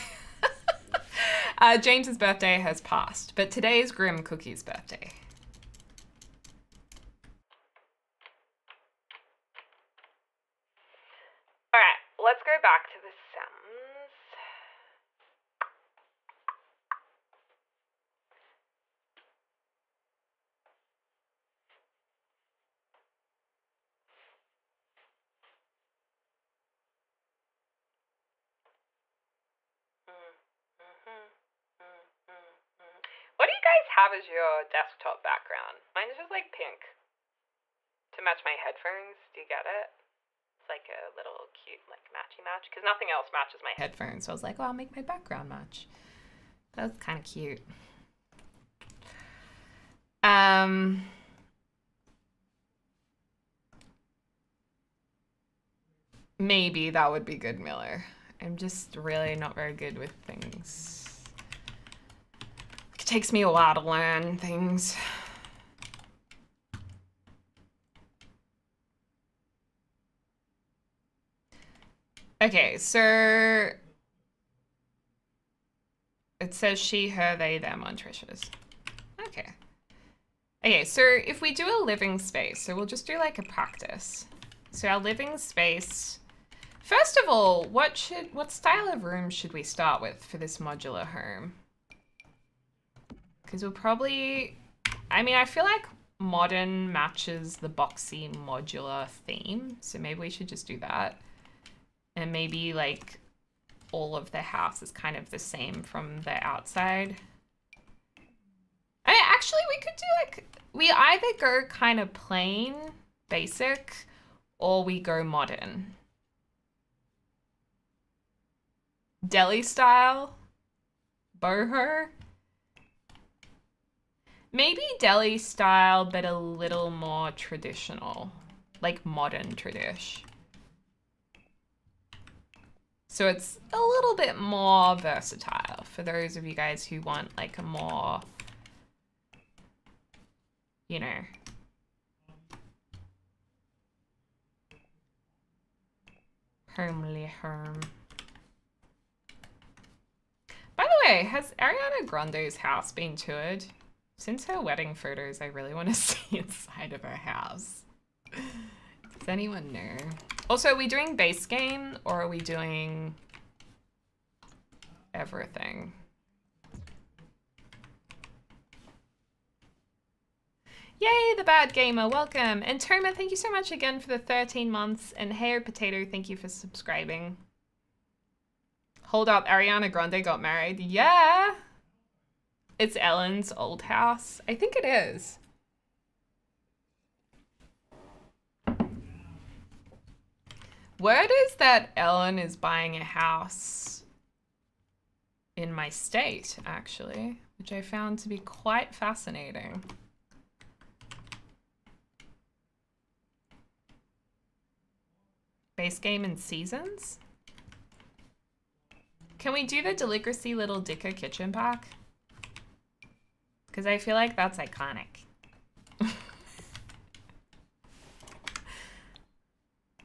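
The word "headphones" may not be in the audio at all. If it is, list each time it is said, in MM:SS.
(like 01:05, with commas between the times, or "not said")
00:38, 00:43.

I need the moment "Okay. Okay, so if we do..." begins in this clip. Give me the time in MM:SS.
01:19.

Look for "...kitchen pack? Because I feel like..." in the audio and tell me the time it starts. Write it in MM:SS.
03:31.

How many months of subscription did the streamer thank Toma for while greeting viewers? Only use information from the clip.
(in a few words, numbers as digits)
13.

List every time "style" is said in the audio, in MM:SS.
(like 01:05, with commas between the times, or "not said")
01:28, 01:59, 02:05.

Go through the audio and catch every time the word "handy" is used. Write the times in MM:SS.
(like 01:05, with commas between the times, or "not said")
not said.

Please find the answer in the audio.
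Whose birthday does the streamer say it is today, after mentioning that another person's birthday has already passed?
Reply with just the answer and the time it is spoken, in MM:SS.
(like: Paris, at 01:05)
Grim Cookie, at 00:03.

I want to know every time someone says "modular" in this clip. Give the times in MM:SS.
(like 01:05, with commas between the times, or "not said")
01:30, 01:38.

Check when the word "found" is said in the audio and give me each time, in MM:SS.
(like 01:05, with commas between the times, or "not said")
03:17.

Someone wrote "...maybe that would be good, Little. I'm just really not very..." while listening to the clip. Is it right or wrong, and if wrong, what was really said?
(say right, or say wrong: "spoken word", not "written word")
wrong: "Miller", not "Little".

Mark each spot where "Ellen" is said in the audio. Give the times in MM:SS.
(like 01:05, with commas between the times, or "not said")
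03:02, 03:11.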